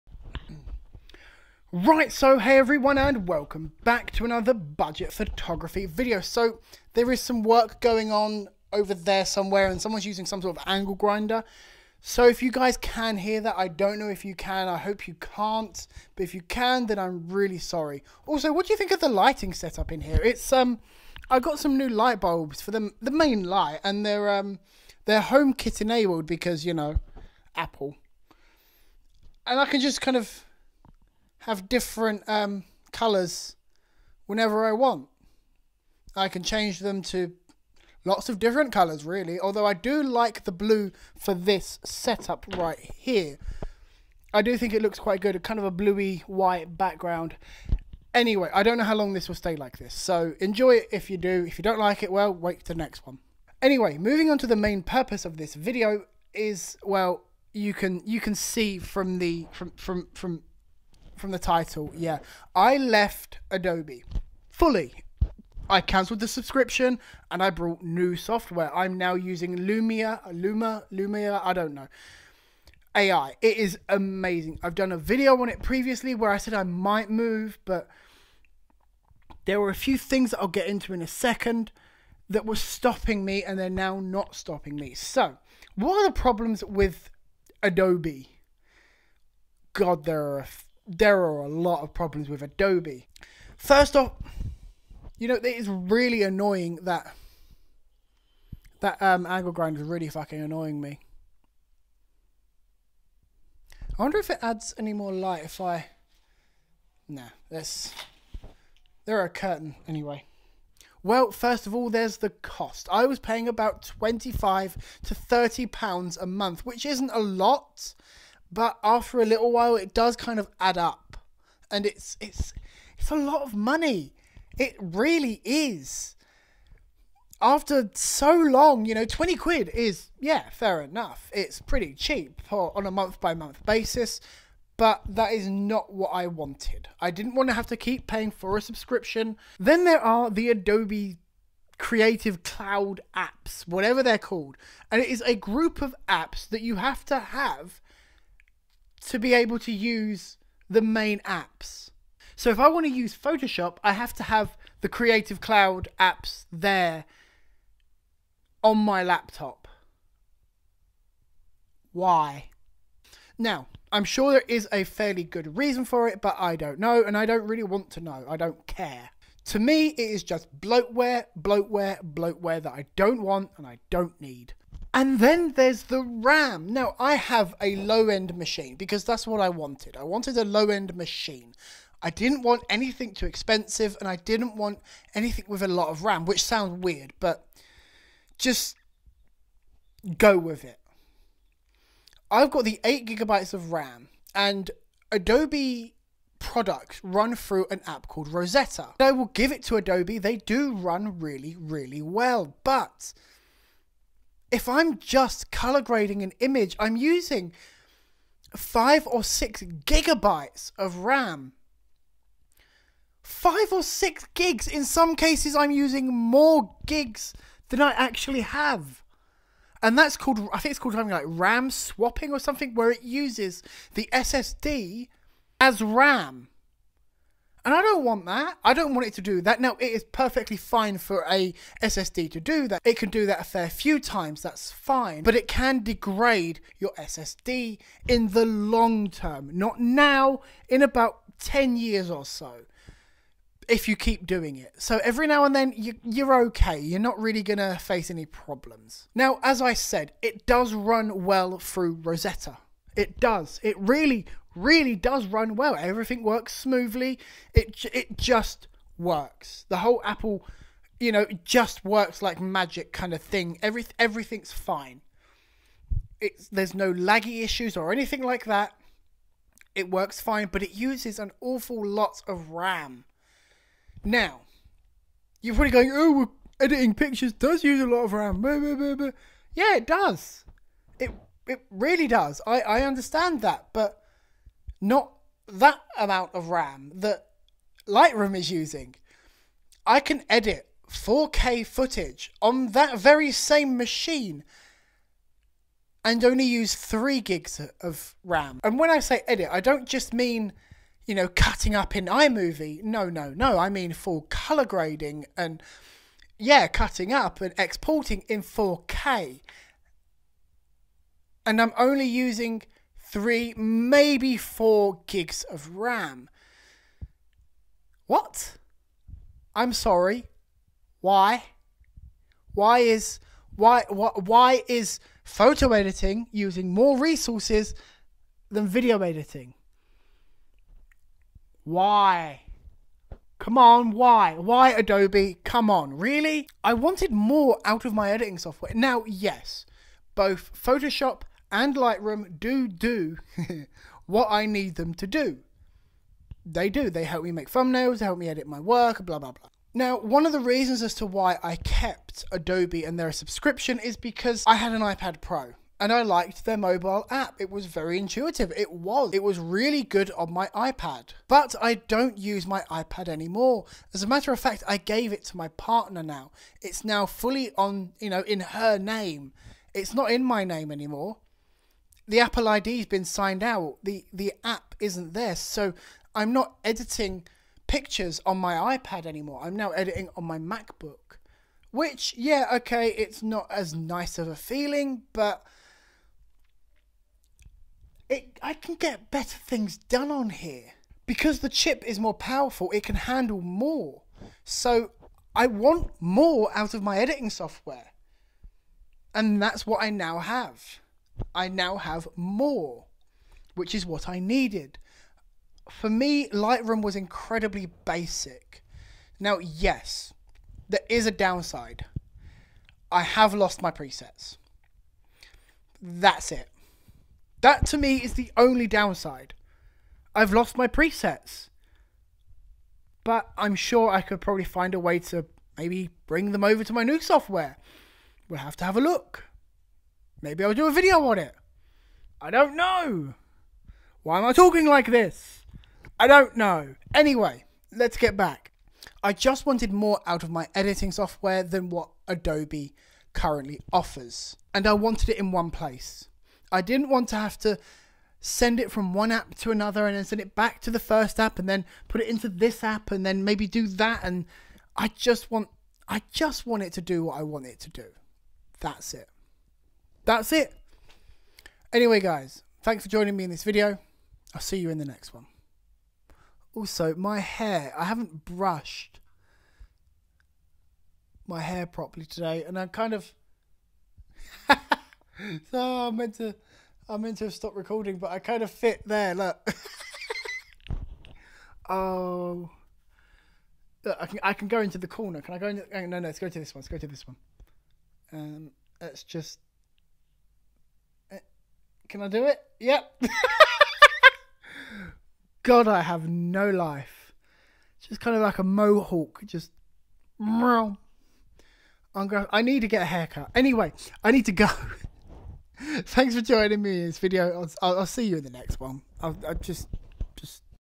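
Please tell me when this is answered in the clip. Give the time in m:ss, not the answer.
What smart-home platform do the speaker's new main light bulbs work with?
0:25.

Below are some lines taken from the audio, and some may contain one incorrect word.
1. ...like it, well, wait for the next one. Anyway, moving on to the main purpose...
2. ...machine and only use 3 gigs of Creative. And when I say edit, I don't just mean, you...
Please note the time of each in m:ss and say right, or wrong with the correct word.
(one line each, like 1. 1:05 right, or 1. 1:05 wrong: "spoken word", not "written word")
1. 0:51 right
2. 4:53 wrong: "RAM", not "Creative".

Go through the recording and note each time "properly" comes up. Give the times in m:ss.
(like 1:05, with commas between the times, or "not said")
7:51.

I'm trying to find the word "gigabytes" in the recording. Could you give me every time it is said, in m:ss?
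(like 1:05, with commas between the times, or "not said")
3:13, 3:29.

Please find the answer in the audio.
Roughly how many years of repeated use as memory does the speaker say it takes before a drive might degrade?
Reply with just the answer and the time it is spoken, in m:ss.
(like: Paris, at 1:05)
10, at 4:01.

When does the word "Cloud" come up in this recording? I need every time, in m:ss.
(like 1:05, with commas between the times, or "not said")
2:22, 2:35.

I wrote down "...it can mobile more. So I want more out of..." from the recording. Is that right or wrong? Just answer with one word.
wrong.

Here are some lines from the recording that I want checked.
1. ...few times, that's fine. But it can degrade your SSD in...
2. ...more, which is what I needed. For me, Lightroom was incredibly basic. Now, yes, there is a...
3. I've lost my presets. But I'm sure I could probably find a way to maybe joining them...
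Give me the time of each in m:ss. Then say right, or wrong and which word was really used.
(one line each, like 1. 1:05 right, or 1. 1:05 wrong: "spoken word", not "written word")
1. 3:53 right
2. 6:42 right
3. 7:00 wrong: "bring", not "joining".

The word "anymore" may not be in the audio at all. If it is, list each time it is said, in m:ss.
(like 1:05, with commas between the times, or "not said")
6:03, 6:10, 6:19.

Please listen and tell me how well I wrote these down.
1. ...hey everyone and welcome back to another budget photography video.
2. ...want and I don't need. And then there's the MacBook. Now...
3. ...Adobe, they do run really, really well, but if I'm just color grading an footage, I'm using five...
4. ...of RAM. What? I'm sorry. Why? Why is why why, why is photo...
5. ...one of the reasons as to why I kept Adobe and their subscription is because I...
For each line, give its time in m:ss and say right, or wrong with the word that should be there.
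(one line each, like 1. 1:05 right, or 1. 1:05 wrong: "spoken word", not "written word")
1. 0:02 right
2. 2:53 wrong: "RAM", not "MacBook"
3. 3:19 wrong: "image", not "footage"
4. 5:15 right
5. 5:49 right.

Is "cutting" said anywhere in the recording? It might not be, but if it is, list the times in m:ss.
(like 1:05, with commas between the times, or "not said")
5:01, 5:06.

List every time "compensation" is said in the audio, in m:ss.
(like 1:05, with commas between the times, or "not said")
not said.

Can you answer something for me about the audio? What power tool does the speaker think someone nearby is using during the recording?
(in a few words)
angle grinder.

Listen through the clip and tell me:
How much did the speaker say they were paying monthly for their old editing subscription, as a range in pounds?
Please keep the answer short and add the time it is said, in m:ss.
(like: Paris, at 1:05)
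25 to 30 pounds, at 1:53.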